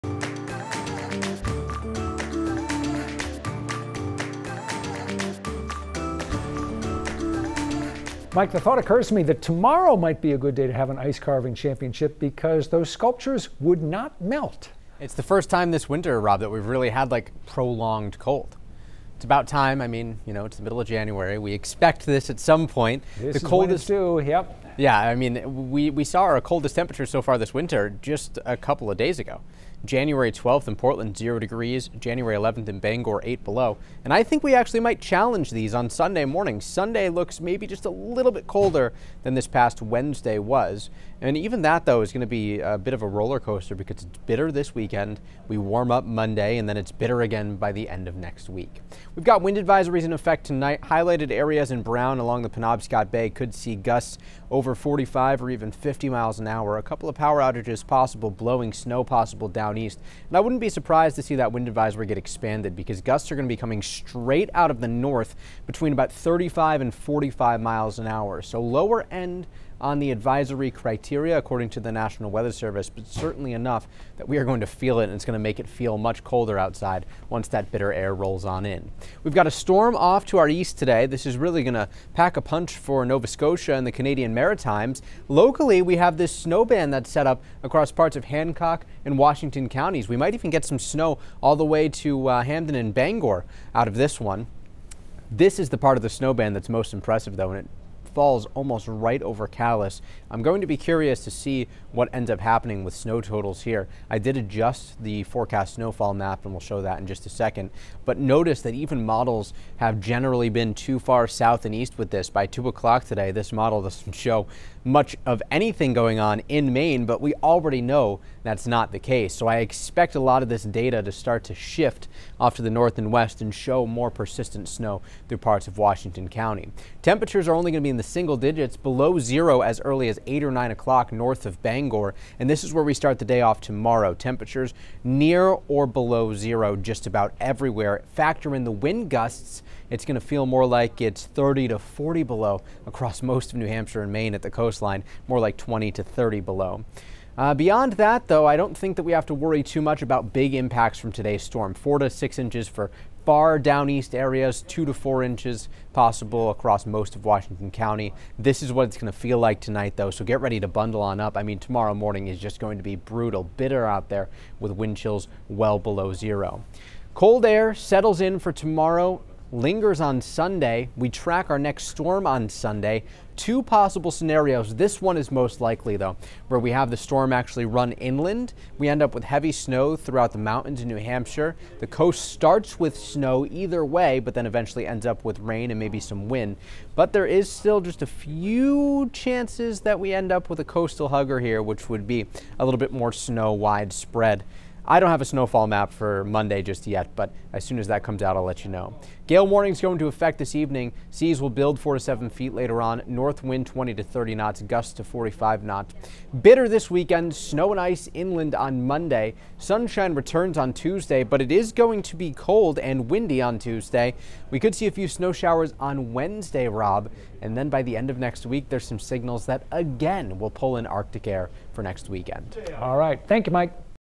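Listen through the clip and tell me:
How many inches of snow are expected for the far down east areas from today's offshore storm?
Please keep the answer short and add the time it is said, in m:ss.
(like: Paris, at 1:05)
4 to 6 inches, at 2:31.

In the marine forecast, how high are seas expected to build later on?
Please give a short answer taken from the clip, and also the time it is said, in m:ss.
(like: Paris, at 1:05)
4 to 7 feet, at 3:21.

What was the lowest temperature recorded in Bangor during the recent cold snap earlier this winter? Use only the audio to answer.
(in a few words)
8 below.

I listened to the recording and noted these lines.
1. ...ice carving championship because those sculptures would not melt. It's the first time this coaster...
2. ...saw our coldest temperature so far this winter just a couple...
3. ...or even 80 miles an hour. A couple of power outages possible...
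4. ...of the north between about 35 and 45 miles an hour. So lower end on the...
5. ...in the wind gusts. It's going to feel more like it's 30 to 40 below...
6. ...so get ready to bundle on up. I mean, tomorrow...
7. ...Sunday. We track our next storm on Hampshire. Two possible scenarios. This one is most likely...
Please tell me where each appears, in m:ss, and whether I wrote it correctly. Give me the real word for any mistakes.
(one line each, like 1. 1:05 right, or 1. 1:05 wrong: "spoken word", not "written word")
1. 0:10 wrong: "winter", not "coaster"
2. 0:26 right
3. 0:55 wrong: "50", not "80"
4. 1:04 right
5. 2:18 right
6. 2:40 right
7. 2:50 wrong: "Sunday", not "Hampshire".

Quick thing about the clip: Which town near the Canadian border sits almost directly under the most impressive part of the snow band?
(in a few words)
Calais.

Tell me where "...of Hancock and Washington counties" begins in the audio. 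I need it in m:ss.
1:28.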